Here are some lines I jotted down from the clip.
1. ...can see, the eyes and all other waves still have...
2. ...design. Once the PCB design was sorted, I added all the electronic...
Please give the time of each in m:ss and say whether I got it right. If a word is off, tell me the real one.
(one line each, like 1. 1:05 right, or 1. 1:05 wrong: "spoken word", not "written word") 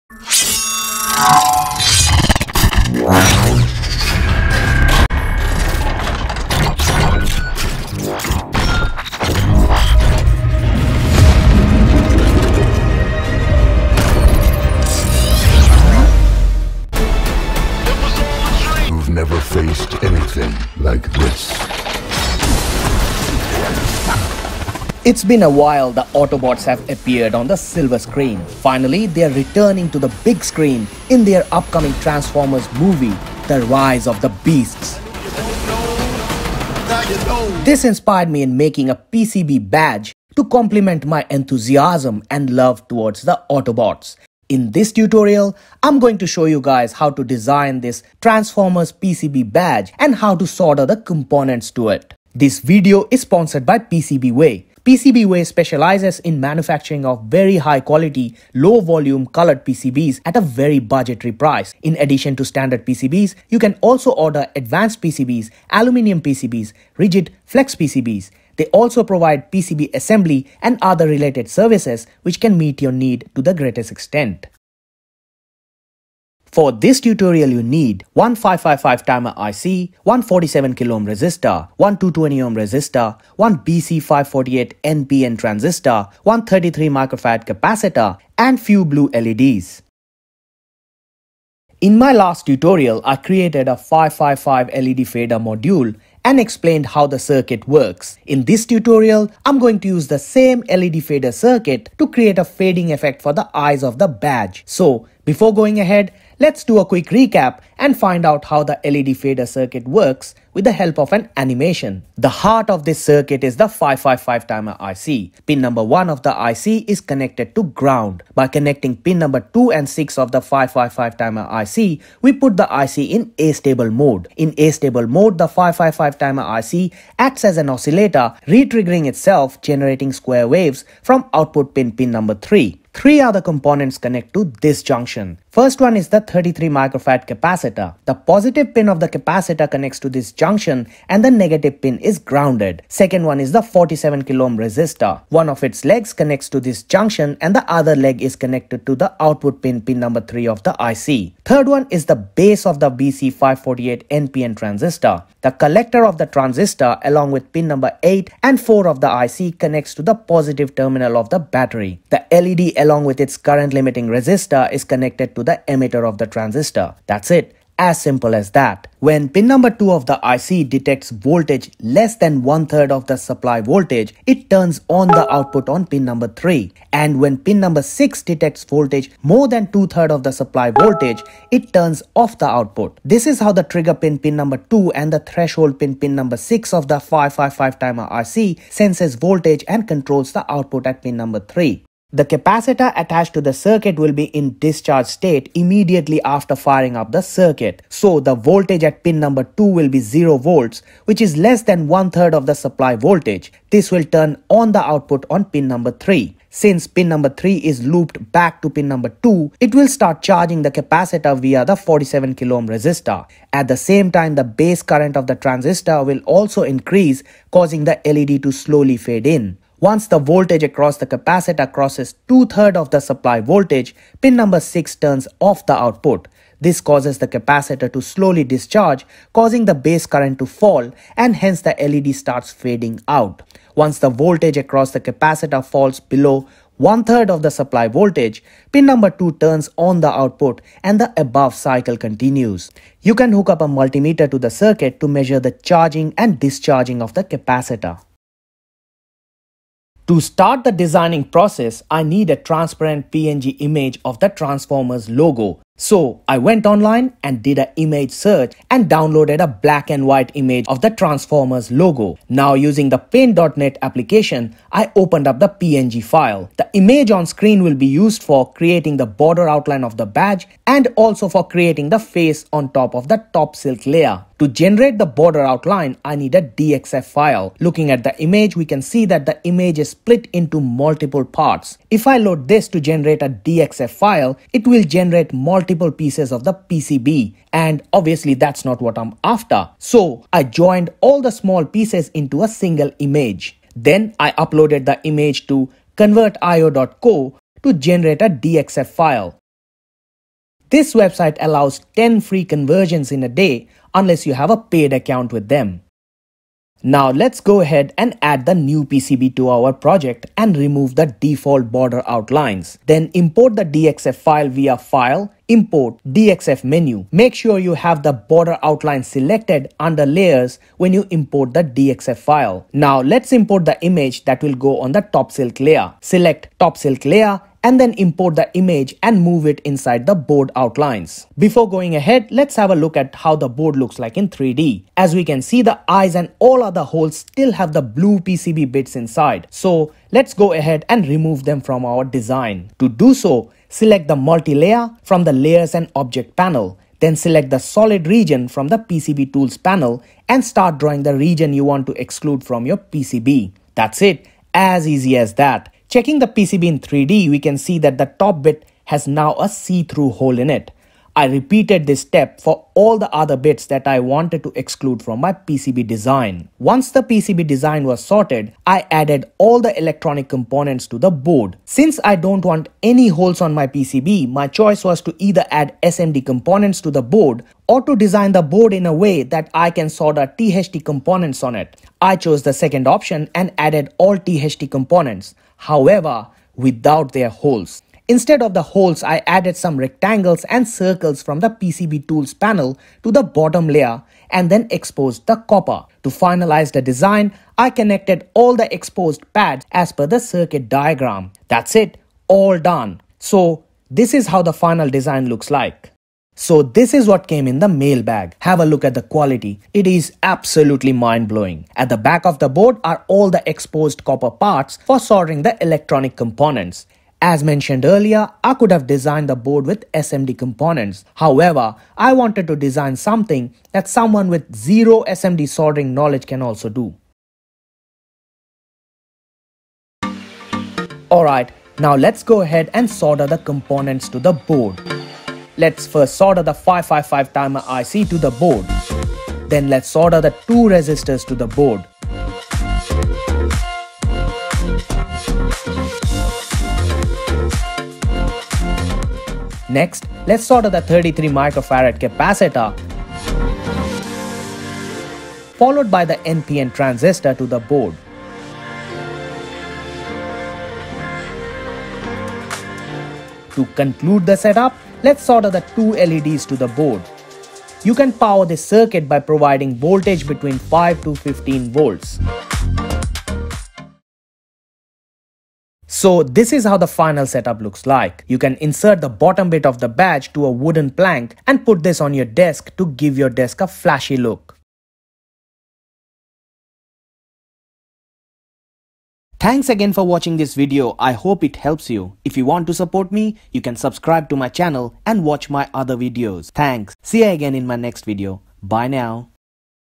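1. 5:35 wrong: "holes", not "waves"
2. 6:05 right.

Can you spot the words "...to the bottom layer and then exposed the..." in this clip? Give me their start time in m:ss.
6:33.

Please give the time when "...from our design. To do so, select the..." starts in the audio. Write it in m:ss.
5:41.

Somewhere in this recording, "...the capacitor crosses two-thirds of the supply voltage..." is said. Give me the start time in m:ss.
3:40.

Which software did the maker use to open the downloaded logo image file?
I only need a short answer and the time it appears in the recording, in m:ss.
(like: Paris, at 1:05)
paint.net, at 4:22.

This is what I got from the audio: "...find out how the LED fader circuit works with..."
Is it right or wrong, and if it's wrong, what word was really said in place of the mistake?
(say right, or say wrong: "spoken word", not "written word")
right.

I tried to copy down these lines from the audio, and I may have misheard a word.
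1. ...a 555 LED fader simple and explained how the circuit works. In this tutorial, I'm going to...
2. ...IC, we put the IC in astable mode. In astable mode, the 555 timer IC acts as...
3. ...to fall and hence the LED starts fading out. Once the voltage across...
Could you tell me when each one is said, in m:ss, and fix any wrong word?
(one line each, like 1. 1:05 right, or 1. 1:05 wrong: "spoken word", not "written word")
1. 1:33 wrong: "module", not "simple"
2. 2:01 right
3. 3:50 right.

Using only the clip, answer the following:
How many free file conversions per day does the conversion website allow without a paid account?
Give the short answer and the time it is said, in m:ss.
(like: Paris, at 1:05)
10, at 5:01.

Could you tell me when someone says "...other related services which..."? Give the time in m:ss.
1:10.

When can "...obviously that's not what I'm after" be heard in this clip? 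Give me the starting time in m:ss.
4:47.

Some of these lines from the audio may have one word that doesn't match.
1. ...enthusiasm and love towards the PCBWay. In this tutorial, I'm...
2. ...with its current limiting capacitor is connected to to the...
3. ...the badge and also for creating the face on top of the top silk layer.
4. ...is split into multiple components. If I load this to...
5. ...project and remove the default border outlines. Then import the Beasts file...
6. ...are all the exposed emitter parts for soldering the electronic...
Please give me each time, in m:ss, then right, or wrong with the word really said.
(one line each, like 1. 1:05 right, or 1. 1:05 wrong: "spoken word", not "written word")
1. 0:41 wrong: "Autobots", not "PCBWay"
2. 2:43 wrong: "resistor", not "capacitor"
3. 4:29 right
4. 4:39 wrong: "parts", not "components"
5. 5:09 wrong: "DXF", not "Beasts"
6. 6:52 wrong: "copper", not "emitter".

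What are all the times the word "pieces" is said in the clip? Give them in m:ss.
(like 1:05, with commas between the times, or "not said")
4:45, 4:51.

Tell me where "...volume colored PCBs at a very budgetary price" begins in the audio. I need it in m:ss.
0:58.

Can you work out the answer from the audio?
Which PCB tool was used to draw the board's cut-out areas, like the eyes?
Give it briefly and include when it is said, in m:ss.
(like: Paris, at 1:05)
solid region, at 5:47.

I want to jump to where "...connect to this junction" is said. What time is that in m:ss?
2:13.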